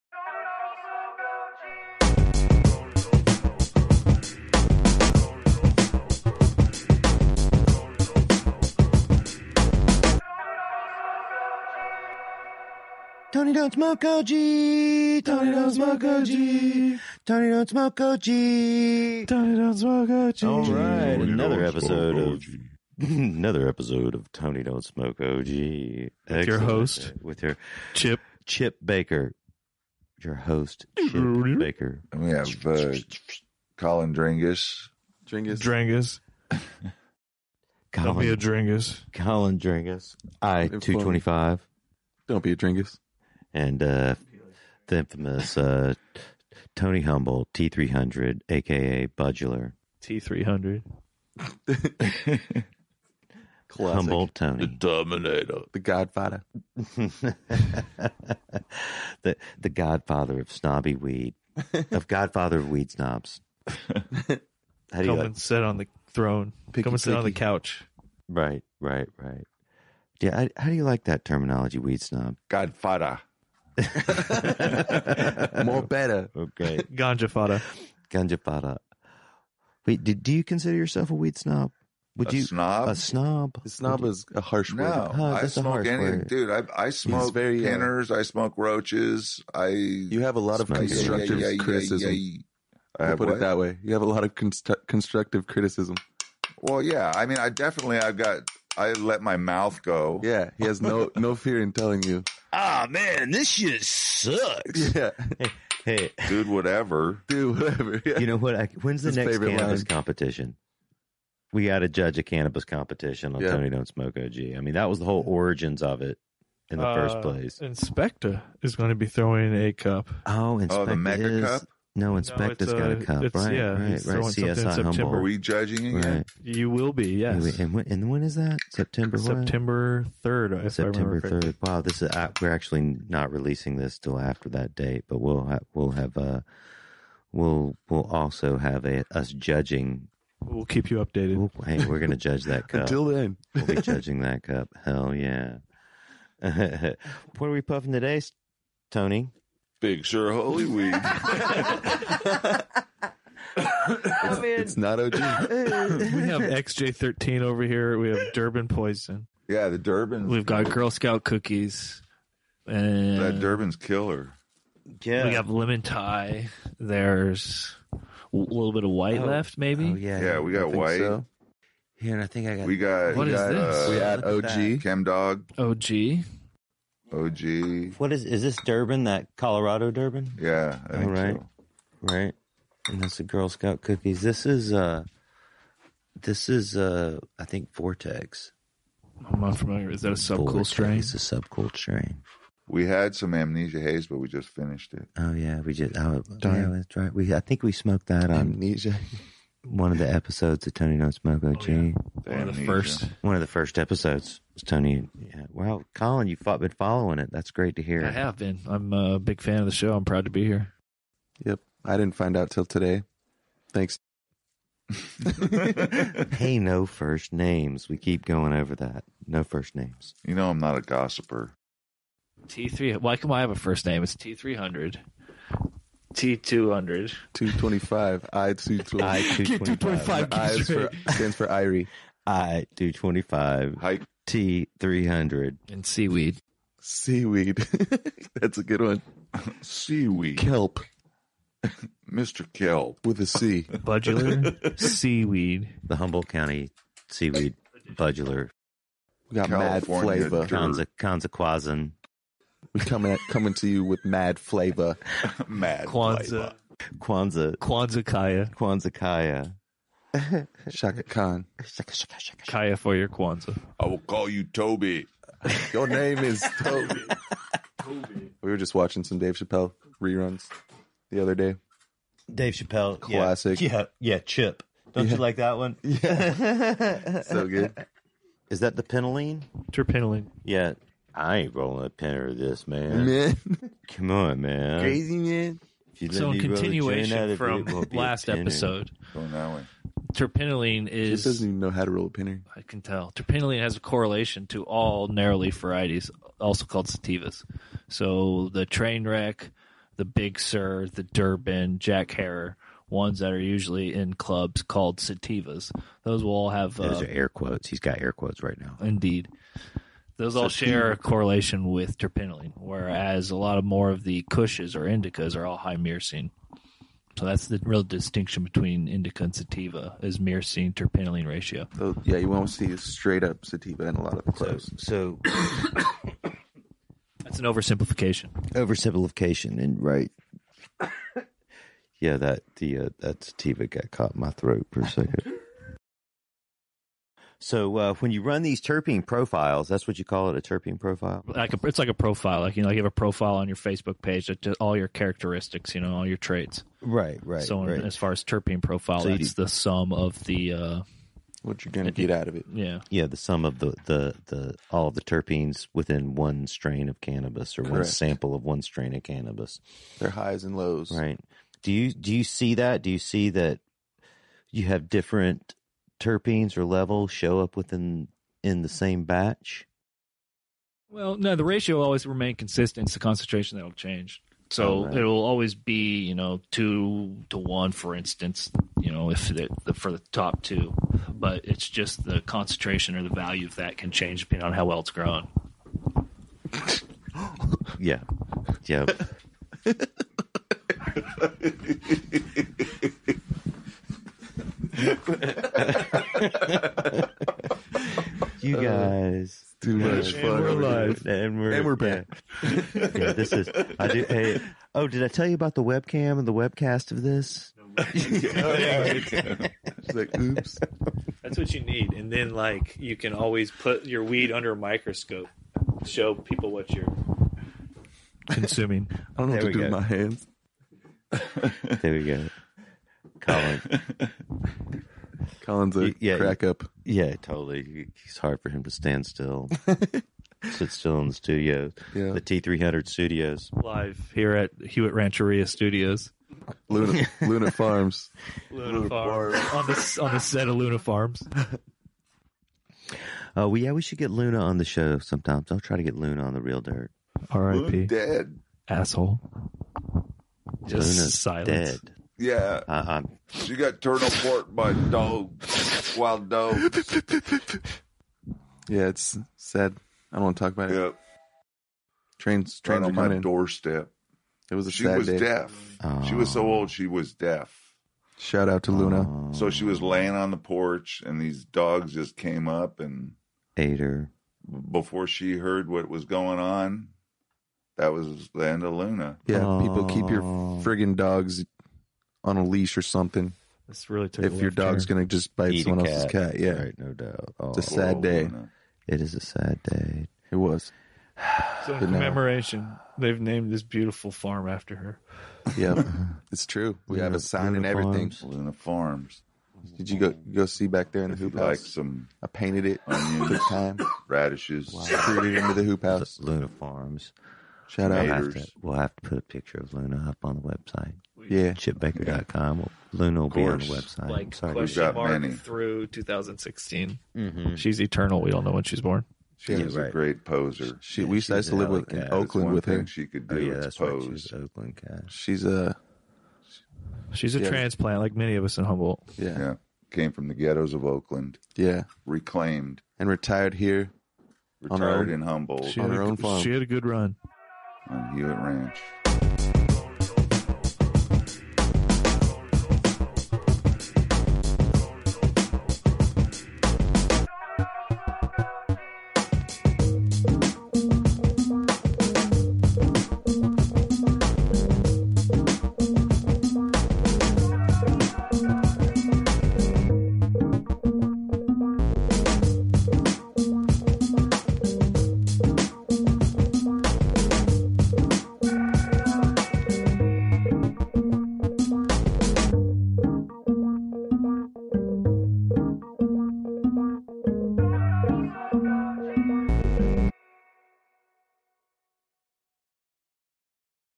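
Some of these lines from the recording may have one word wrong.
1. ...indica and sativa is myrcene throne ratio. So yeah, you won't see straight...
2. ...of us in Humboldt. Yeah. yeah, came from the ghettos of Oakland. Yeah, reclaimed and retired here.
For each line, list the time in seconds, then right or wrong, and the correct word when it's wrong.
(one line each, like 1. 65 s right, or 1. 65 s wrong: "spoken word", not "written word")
1. 318 s wrong: "terpinolene", not "throne"
2. 528 s right.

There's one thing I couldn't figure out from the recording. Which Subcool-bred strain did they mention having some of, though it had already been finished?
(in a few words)
Amnesia Haze.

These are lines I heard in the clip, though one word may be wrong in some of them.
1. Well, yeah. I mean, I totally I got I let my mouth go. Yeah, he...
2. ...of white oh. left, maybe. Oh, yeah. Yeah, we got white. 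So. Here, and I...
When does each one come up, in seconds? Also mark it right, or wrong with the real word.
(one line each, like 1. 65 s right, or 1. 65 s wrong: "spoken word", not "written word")
1. 96 s wrong: "definitely", not "totally"
2. 168 s right.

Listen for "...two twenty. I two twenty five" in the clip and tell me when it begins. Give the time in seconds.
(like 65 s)
228 s.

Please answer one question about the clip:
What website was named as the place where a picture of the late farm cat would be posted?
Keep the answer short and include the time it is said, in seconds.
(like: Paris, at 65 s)
chipbaker.com, at 511 s.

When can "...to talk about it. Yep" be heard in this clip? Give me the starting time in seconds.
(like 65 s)
460 s.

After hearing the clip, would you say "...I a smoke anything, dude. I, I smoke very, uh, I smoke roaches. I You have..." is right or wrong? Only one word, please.
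right.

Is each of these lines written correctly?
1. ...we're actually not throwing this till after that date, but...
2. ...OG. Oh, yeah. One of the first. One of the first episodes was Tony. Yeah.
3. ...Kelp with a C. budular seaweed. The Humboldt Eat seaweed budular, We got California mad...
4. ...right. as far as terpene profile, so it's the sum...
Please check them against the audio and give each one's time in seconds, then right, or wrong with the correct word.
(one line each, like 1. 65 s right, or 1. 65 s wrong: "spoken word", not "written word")
1. 132 s wrong: "releasing", not "throwing"
2. 201 s right
3. 242 s wrong: "County", not "Eat"
4. 347 s right.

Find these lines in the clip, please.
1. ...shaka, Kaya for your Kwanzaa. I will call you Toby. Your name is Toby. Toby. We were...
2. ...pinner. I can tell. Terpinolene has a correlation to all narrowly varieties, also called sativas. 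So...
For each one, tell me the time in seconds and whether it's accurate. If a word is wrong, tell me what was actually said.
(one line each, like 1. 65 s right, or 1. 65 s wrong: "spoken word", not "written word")
1. 262 s right
2. 292 s right.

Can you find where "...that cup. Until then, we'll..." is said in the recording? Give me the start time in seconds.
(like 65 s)
142 s.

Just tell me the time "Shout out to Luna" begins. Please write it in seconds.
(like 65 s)
468 s.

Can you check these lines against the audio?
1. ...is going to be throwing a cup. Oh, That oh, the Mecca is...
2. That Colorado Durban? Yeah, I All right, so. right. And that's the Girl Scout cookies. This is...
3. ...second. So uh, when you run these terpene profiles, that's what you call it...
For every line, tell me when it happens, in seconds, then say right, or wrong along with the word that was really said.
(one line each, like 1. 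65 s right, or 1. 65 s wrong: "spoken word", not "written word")
1. 118 s wrong: "Inspector", not "That"
2. 179 s right
3. 334 s right.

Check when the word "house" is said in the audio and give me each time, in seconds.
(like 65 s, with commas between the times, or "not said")
501 s, 505 s.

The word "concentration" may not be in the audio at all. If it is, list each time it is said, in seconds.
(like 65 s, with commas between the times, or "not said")
372 s, 382 s.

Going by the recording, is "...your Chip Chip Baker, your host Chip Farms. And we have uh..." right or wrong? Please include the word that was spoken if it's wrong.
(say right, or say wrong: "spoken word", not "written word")
wrong: "Baker", not "Farms".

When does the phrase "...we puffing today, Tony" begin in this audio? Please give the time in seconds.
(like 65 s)
147 s.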